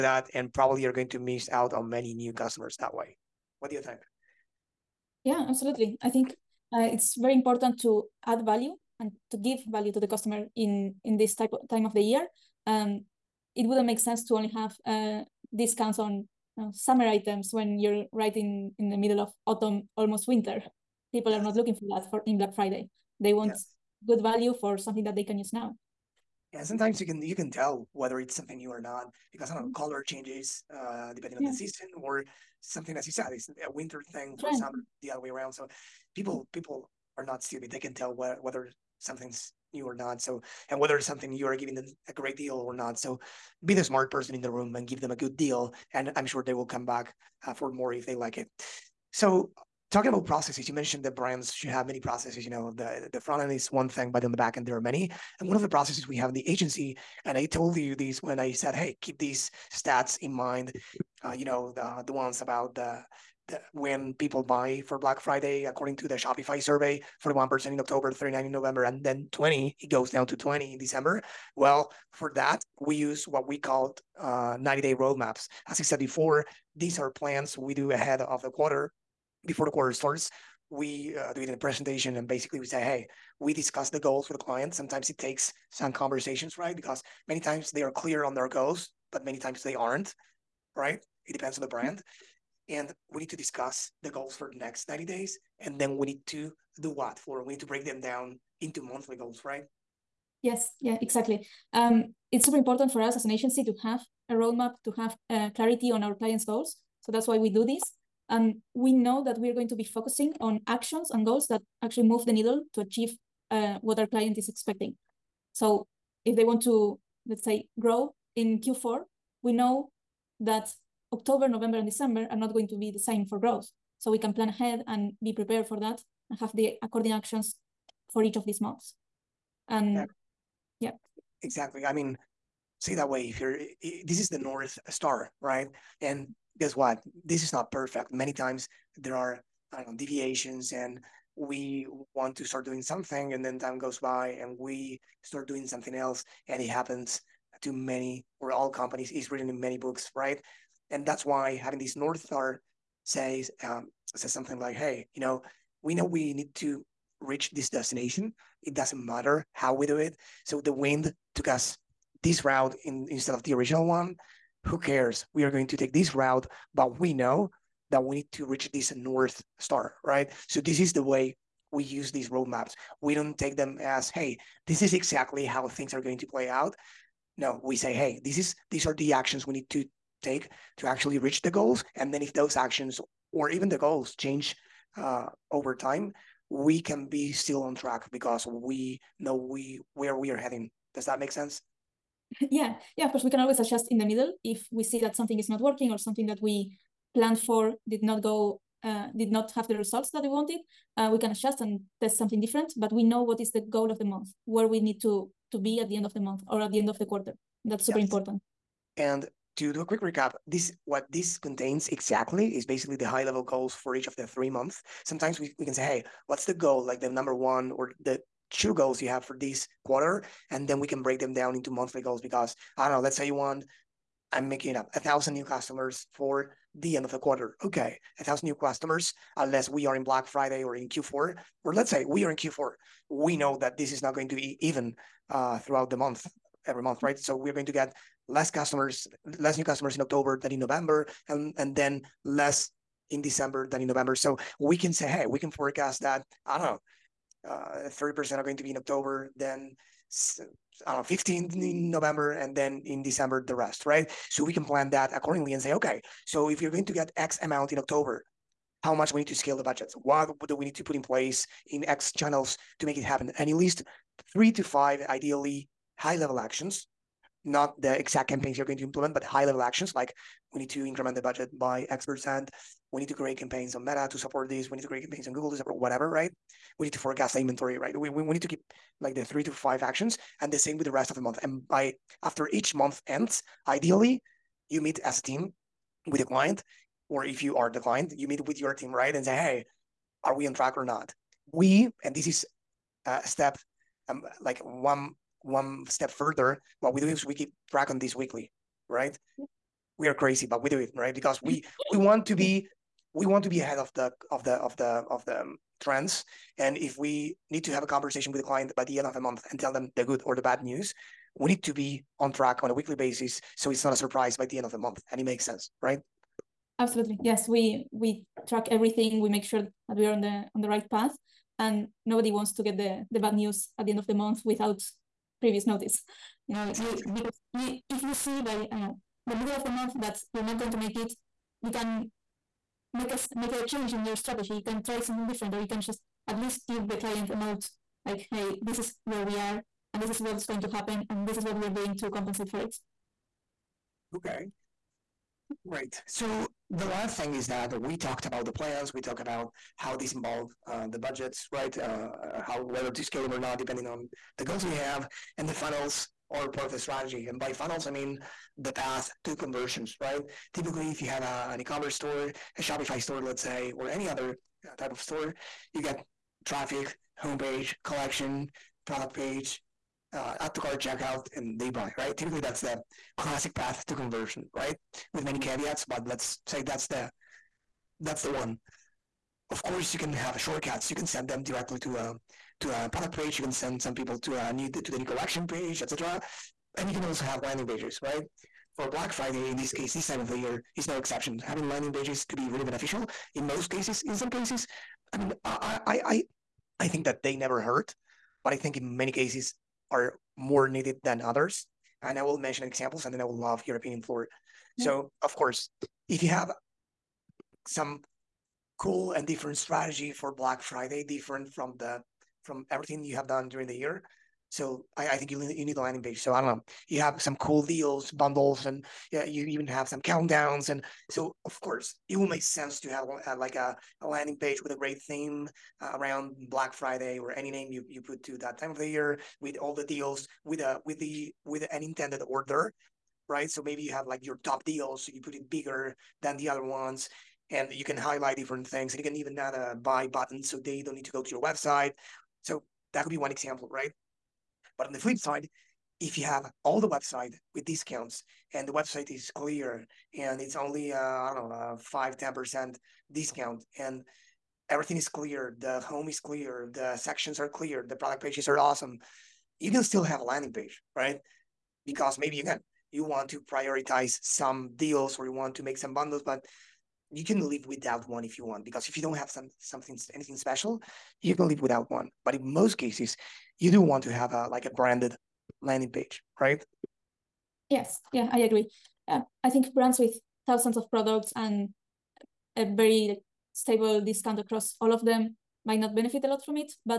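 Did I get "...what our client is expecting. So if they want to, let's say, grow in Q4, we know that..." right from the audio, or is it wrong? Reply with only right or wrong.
right.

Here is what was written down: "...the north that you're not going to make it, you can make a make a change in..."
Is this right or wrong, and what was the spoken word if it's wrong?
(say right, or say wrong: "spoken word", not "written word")
wrong: "month", not "north".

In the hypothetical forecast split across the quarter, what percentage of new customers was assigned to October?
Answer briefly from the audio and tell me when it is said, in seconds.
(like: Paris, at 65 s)
30%, at 247 s.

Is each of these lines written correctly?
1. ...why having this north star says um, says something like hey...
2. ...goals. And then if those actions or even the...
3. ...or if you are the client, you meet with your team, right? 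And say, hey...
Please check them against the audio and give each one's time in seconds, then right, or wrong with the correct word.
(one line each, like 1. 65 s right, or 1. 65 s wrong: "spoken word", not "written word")
1. 151 s right
2. 181 s right
3. 287 s right.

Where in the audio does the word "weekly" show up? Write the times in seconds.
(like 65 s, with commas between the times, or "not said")
298 s, 312 s.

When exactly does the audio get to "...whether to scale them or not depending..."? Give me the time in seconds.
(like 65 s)
352 s.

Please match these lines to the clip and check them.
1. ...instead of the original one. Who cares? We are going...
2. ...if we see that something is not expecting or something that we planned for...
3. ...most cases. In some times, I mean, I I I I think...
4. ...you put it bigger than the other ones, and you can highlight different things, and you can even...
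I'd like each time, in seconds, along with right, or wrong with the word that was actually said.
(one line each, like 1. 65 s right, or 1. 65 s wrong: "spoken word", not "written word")
1. 163 s right
2. 194 s wrong: "working", not "expecting"
3. 393 s wrong: "cases", not "times"
4. 435 s right.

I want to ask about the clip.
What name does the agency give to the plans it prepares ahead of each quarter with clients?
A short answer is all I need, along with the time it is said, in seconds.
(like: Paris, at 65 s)
90 day roadmaps, at 74 s.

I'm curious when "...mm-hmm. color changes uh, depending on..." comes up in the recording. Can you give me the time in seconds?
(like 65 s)
29 s.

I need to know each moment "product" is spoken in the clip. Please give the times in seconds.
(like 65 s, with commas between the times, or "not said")
368 s, 382 s, 457 s, 480 s.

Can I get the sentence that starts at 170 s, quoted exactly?
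So this is the way we use these roadmaps.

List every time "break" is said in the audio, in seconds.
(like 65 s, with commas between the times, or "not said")
97 s, 221 s.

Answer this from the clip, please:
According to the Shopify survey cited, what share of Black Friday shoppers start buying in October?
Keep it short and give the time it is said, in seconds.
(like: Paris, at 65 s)
41%, at 67 s.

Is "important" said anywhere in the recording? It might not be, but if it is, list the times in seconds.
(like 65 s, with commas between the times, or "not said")
7 s, 102 s, 208 s.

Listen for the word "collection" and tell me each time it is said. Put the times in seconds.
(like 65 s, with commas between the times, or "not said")
367 s, 385 s.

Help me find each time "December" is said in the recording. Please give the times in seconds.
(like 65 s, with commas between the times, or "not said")
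70 s, 121 s, 243 s, 253 s.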